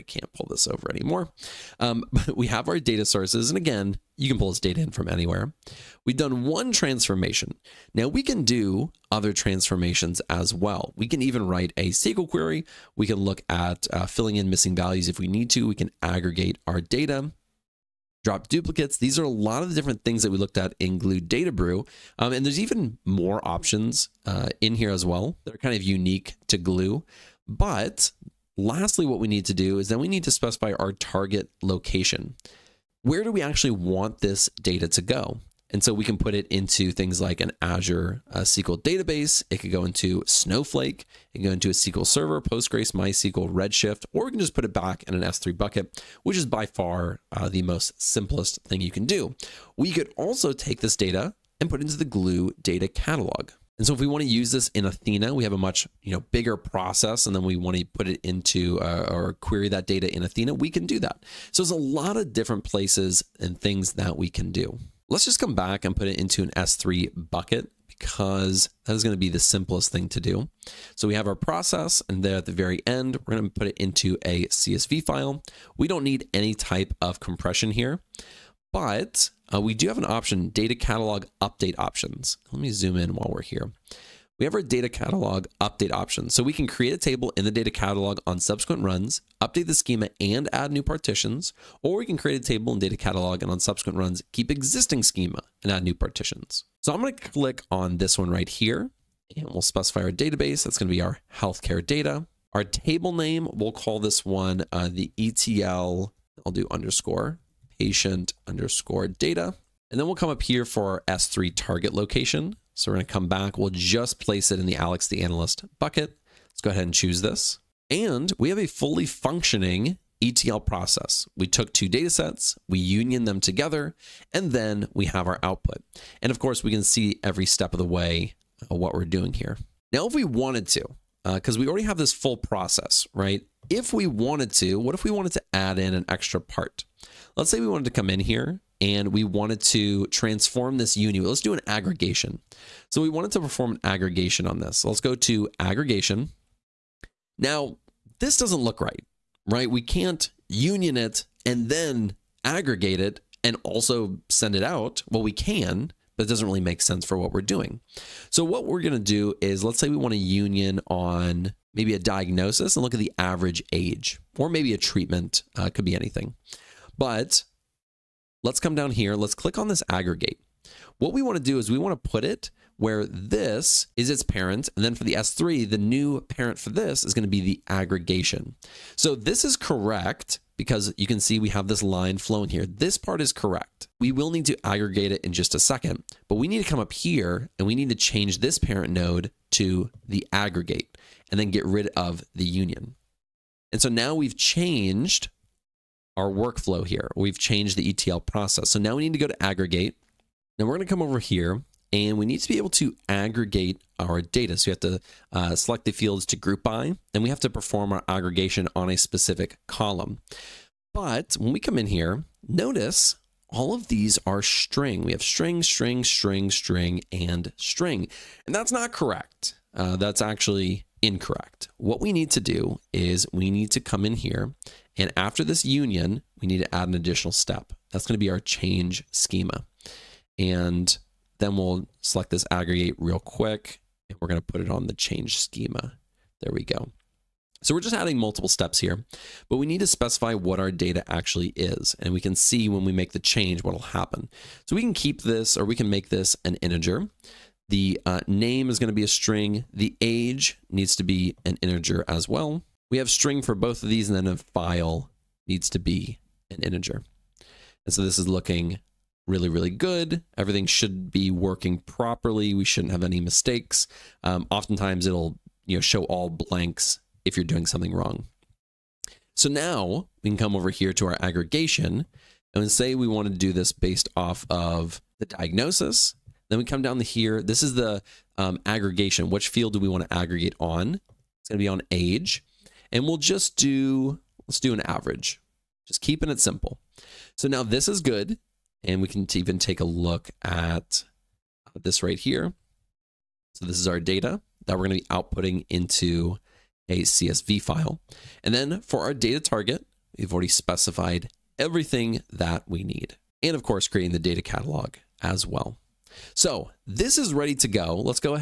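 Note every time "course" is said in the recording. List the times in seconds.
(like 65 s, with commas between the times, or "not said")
126 s, 303 s.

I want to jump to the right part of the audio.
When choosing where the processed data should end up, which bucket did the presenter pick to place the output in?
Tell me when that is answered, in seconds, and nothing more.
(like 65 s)
114 s.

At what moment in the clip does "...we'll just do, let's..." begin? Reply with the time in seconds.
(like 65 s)
283 s.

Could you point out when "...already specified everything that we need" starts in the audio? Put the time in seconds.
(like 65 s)
300 s.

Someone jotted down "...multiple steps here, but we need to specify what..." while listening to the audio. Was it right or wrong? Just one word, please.
right.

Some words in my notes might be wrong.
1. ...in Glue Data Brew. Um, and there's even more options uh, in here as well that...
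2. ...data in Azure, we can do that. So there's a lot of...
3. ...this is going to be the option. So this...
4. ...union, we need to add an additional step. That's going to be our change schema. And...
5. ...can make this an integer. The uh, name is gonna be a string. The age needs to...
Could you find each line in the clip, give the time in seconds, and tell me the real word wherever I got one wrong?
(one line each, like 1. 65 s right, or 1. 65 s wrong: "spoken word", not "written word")
1. 20 s right
2. 59 s wrong: "Athena", not "Azure"
3. 176 s wrong: "aggregation", not "option"
4. 225 s right
5. 245 s right.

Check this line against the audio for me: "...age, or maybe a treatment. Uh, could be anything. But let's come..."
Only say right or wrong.
right.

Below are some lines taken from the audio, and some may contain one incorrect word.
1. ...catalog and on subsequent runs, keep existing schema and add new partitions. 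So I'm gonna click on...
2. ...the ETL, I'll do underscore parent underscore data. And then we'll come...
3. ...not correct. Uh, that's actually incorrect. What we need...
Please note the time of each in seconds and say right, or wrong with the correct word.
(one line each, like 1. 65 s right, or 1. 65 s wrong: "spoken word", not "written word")
1. 92 s right
2. 104 s wrong: "patient", not "parent"
3. 218 s right.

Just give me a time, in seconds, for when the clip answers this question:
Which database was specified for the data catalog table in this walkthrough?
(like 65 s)
101 s.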